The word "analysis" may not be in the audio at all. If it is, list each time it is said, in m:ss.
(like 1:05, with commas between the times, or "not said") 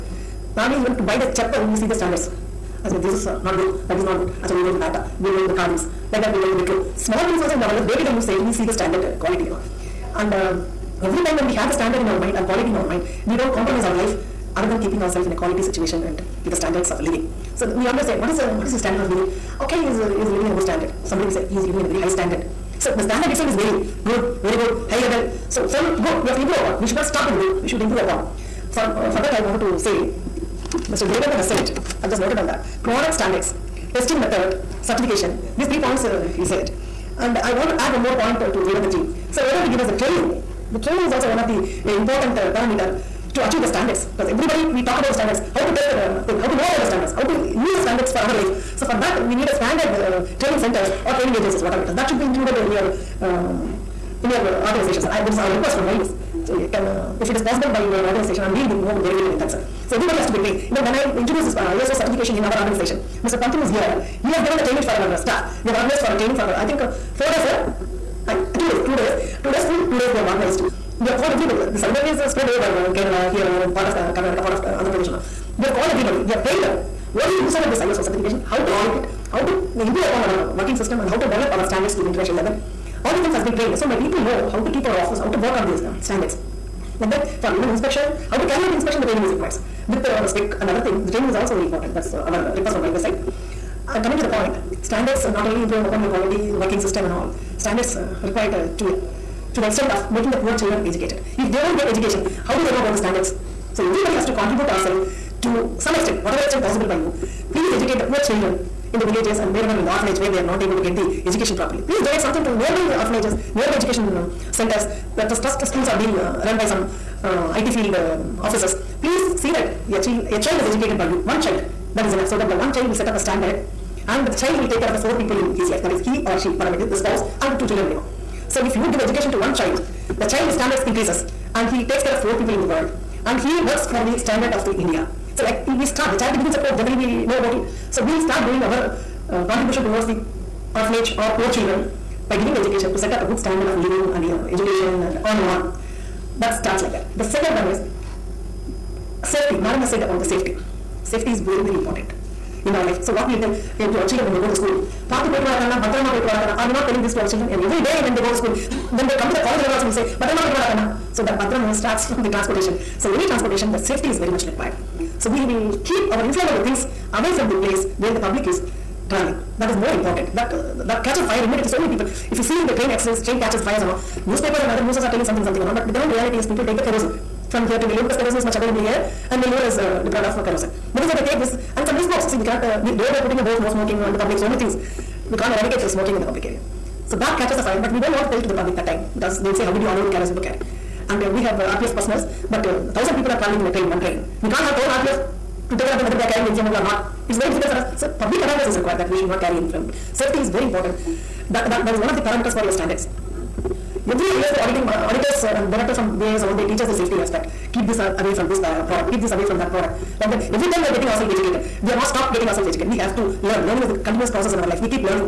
not said.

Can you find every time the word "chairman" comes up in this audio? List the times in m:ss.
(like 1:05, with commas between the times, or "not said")
not said.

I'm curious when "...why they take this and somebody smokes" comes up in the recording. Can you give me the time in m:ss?
3:01.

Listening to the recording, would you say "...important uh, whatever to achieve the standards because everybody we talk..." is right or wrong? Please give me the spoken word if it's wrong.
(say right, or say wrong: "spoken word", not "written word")
wrong: "parameter", not "whatever".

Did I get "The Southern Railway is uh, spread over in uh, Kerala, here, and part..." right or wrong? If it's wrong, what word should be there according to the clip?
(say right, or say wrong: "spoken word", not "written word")
right.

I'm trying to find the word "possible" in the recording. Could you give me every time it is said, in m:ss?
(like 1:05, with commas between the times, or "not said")
0:57, 1:46.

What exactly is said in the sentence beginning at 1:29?
With uh, our spec and other thing, the training is also very important.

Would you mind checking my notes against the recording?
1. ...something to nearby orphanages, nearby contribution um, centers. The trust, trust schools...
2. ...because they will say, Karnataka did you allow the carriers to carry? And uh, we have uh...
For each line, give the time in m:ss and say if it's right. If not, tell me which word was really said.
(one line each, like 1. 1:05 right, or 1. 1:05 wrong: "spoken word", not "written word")
1. 1:52 wrong: "education", not "contribution"
2. 3:09 wrong: "How", not "Karnataka".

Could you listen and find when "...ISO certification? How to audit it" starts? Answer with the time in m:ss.
1:17.